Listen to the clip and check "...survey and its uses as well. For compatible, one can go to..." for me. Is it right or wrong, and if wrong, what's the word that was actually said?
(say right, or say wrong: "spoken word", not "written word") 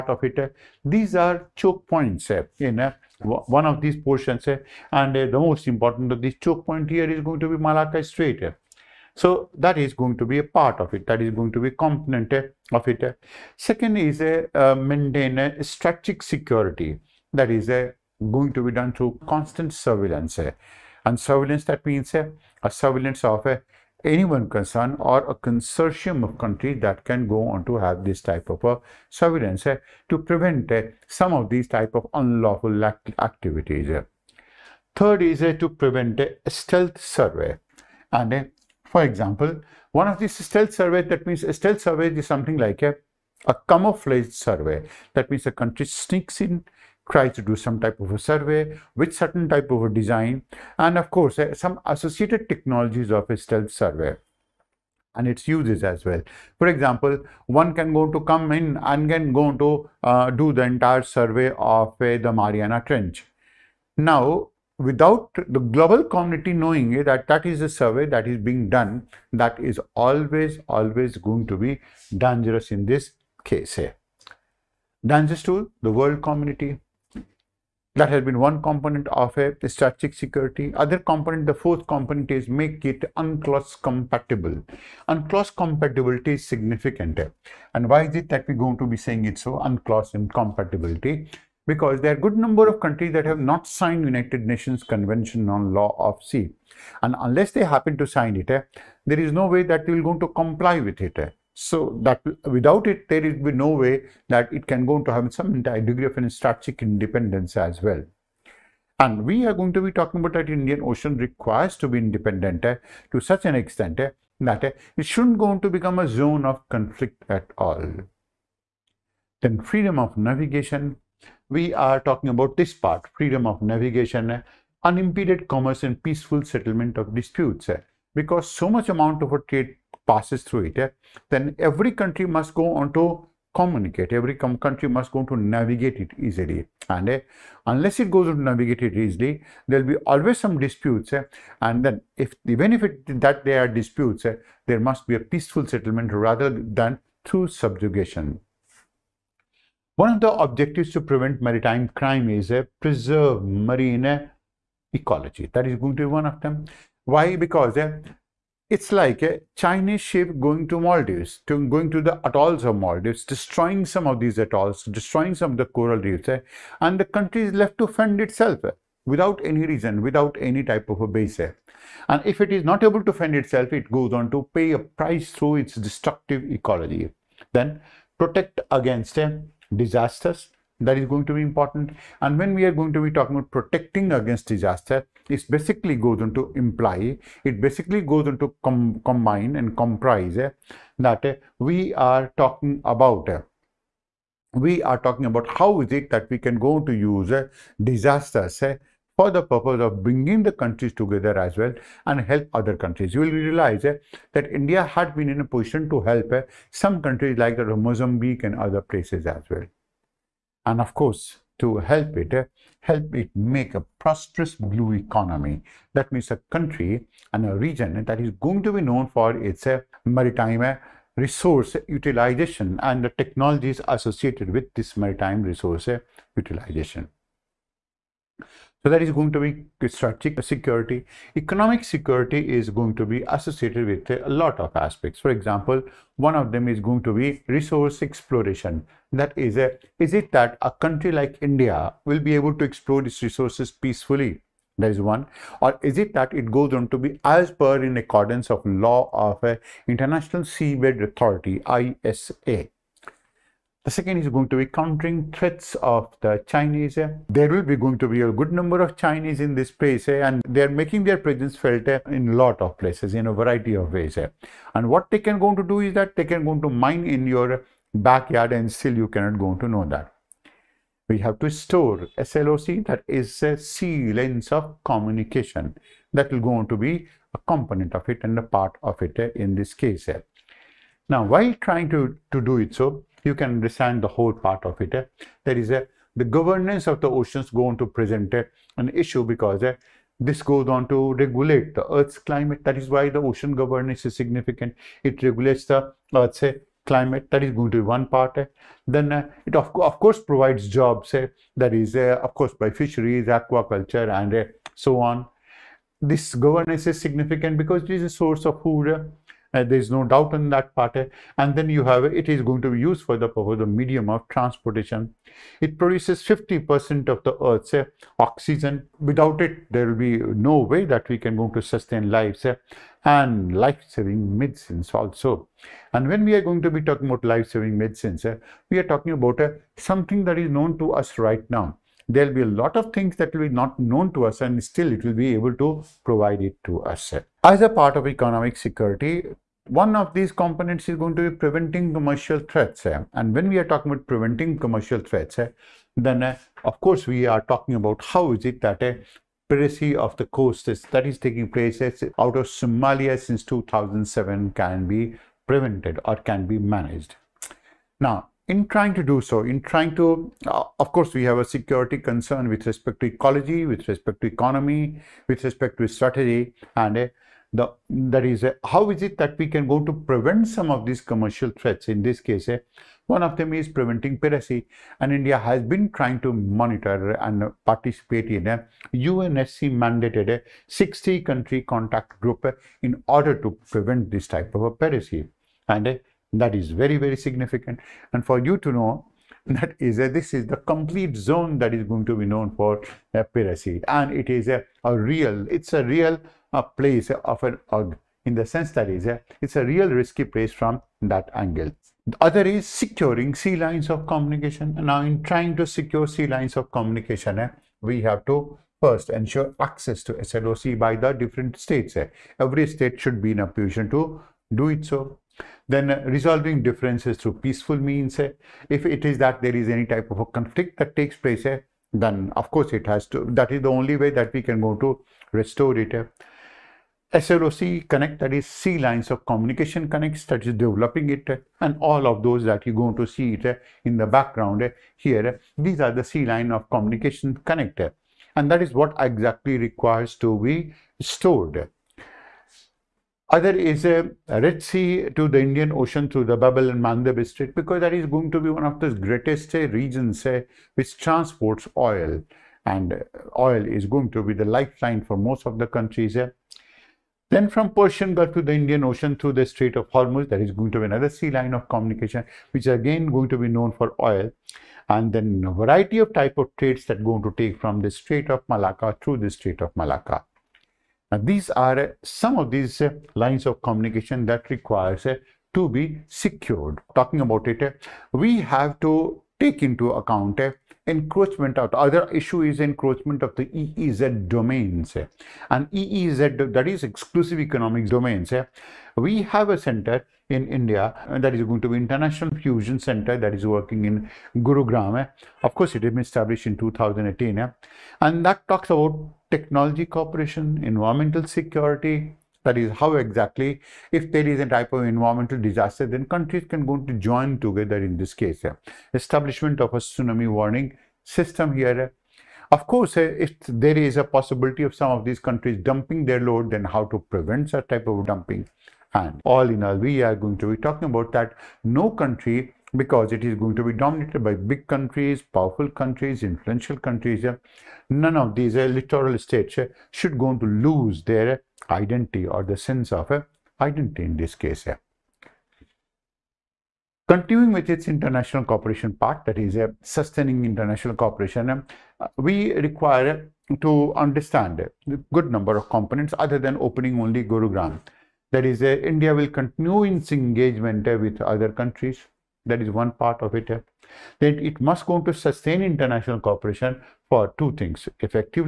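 wrong: "example", not "compatible".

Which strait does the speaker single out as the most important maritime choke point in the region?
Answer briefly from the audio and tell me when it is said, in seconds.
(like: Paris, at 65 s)
Malacca Strait, at 7 s.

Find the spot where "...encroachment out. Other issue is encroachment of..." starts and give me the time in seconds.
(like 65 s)
480 s.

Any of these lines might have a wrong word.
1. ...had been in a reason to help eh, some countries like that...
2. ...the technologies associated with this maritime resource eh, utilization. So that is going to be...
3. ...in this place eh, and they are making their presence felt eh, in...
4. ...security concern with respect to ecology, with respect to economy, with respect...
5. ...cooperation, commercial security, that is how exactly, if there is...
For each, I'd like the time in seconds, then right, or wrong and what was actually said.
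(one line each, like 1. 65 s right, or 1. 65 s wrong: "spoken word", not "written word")
1. 204 s wrong: "position", not "reason"
2. 223 s right
3. 259 s right
4. 361 s right
5. 499 s wrong: "environmental", not "commercial".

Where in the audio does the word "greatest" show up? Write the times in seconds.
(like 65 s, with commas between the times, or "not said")
448 s.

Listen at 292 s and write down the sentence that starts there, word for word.
That is why the ocean governance is significant.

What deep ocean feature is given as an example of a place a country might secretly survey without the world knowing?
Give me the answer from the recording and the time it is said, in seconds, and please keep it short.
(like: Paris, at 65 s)
Mariana Trench, at 62 s.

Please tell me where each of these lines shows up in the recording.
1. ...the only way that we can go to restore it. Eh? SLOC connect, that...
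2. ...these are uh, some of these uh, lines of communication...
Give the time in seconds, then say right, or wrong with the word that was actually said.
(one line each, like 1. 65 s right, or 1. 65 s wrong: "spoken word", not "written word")
1. 423 s right
2. 471 s right.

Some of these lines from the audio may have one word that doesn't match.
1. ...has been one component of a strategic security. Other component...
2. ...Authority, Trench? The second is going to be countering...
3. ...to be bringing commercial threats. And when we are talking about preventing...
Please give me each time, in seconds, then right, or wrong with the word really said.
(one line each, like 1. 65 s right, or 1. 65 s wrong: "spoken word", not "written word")
1. 78 s right
2. 251 s wrong: "ISA", not "Trench"
3. 341 s wrong: "preventing", not "bringing".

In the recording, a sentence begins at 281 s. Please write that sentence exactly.
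Now while trying to, to do it so, you can understand the whole part of it.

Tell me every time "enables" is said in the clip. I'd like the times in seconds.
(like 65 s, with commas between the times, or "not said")
not said.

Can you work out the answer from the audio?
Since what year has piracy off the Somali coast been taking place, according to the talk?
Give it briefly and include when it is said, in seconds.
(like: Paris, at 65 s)
2007, at 353 s.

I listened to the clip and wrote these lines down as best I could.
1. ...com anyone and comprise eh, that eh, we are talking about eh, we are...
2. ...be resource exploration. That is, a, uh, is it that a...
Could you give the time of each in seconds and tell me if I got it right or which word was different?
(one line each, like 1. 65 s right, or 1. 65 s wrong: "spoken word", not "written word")
1. 188 s wrong: "combine", not "anyone"
2. 237 s right.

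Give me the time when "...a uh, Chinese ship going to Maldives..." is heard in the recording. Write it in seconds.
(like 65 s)
159 s.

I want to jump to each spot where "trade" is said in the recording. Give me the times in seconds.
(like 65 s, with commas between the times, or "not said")
129 s, 466 s.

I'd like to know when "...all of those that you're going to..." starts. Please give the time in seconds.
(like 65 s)
431 s.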